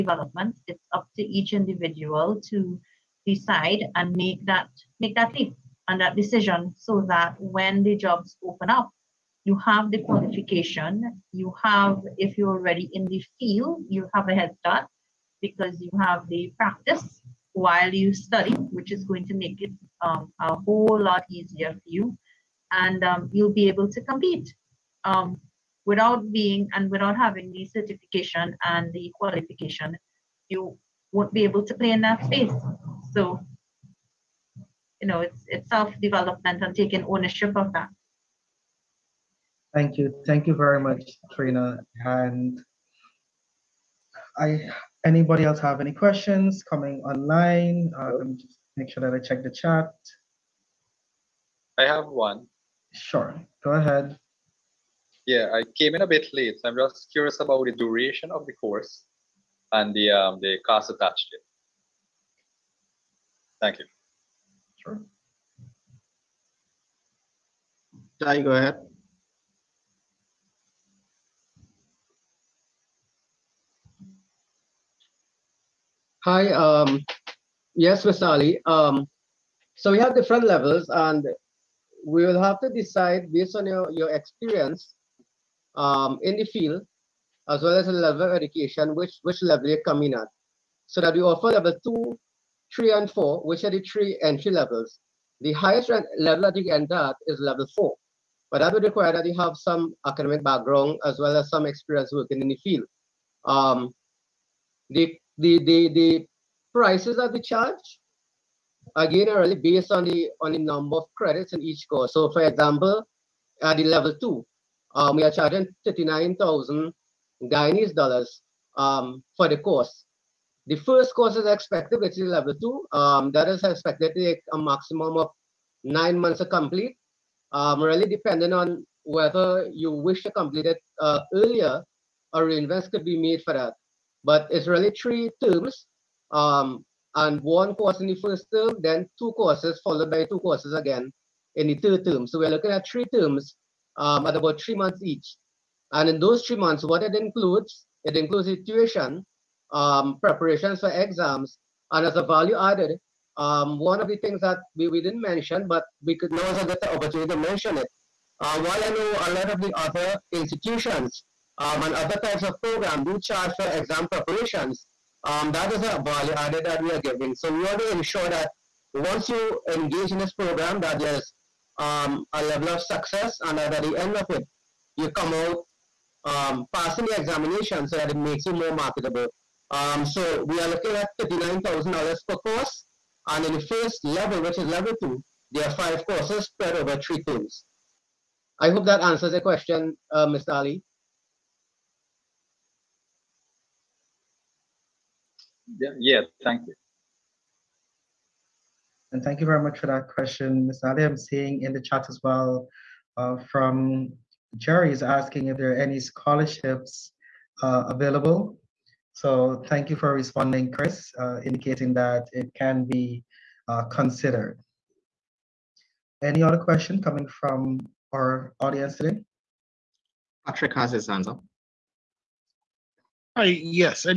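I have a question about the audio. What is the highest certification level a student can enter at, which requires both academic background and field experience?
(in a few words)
Level 4.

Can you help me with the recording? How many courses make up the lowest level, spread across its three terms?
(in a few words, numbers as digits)
5.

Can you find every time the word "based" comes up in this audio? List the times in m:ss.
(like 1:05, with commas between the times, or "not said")
1:23, 1:49.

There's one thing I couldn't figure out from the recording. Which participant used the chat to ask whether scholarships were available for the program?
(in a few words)
Jerry.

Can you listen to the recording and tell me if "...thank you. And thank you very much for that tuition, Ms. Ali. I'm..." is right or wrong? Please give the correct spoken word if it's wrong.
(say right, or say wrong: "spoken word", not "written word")
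wrong: "question", not "tuition".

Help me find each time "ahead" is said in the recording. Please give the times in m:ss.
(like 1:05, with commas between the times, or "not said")
0:53, 1:08.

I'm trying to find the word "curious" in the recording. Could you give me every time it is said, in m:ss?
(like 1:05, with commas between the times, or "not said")
0:57.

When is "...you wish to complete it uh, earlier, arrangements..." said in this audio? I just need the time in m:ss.
2:09.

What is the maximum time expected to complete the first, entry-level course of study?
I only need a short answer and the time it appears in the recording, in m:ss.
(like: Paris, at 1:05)
9 months, at 2:05.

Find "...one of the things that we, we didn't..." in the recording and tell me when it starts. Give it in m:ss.
2:33.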